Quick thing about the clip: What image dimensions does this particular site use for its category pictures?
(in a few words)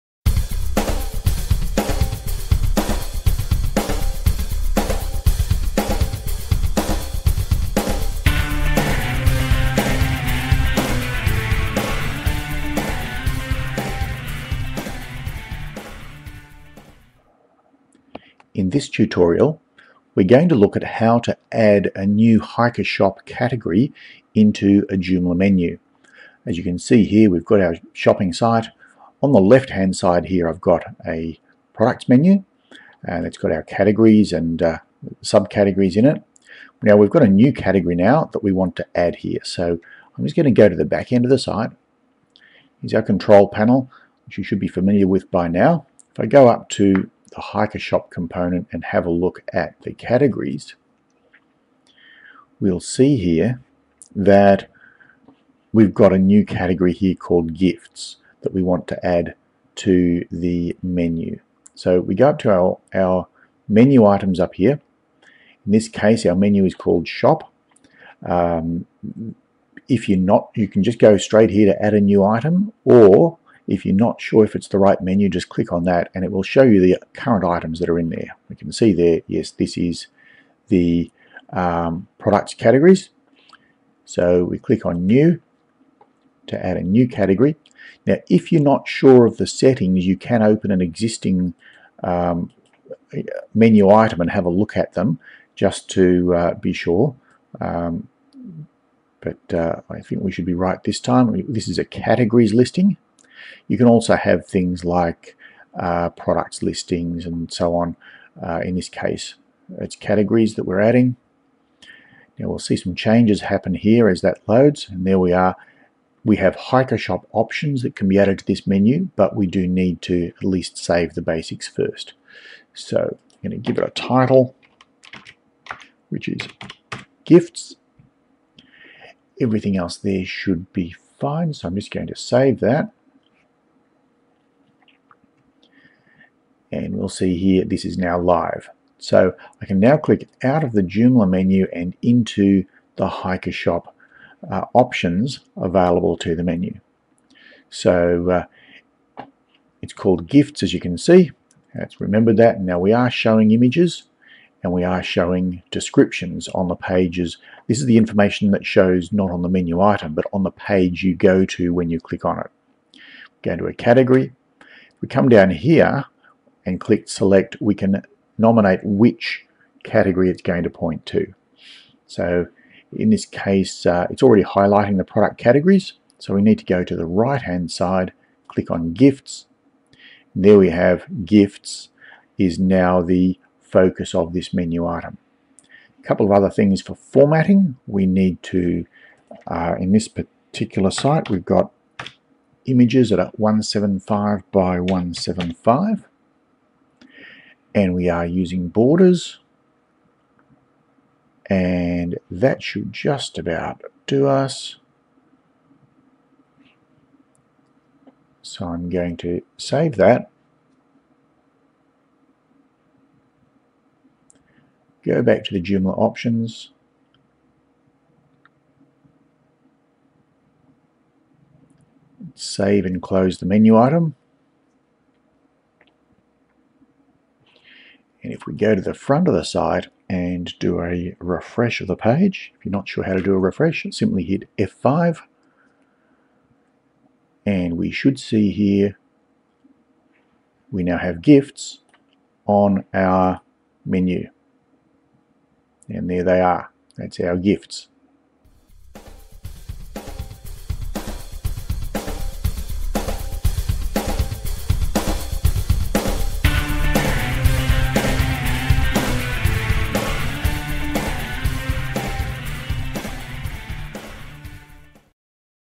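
175 by 175.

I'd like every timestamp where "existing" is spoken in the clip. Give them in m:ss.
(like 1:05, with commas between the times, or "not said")
1:30.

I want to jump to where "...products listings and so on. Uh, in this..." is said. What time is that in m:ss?
1:46.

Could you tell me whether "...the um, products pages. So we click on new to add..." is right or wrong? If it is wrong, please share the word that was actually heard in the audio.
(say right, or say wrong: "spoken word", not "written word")
wrong: "categories", not "pages".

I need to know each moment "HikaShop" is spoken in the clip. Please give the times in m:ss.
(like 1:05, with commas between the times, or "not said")
0:22, 0:47, 1:56, 2:23.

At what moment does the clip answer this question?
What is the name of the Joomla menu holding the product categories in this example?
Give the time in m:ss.
1:07.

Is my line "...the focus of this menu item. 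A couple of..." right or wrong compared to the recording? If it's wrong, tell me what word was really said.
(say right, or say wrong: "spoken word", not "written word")
right.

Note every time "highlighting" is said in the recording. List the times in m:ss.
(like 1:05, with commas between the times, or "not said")
2:54.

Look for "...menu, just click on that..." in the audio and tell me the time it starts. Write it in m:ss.
1:15.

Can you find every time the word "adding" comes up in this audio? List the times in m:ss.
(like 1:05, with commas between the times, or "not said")
1:50.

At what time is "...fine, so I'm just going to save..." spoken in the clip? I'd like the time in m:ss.
2:11.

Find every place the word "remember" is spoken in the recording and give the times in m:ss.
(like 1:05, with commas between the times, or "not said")
2:31.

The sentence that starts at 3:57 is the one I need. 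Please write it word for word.
And we should see here, we now have gifts on our menu.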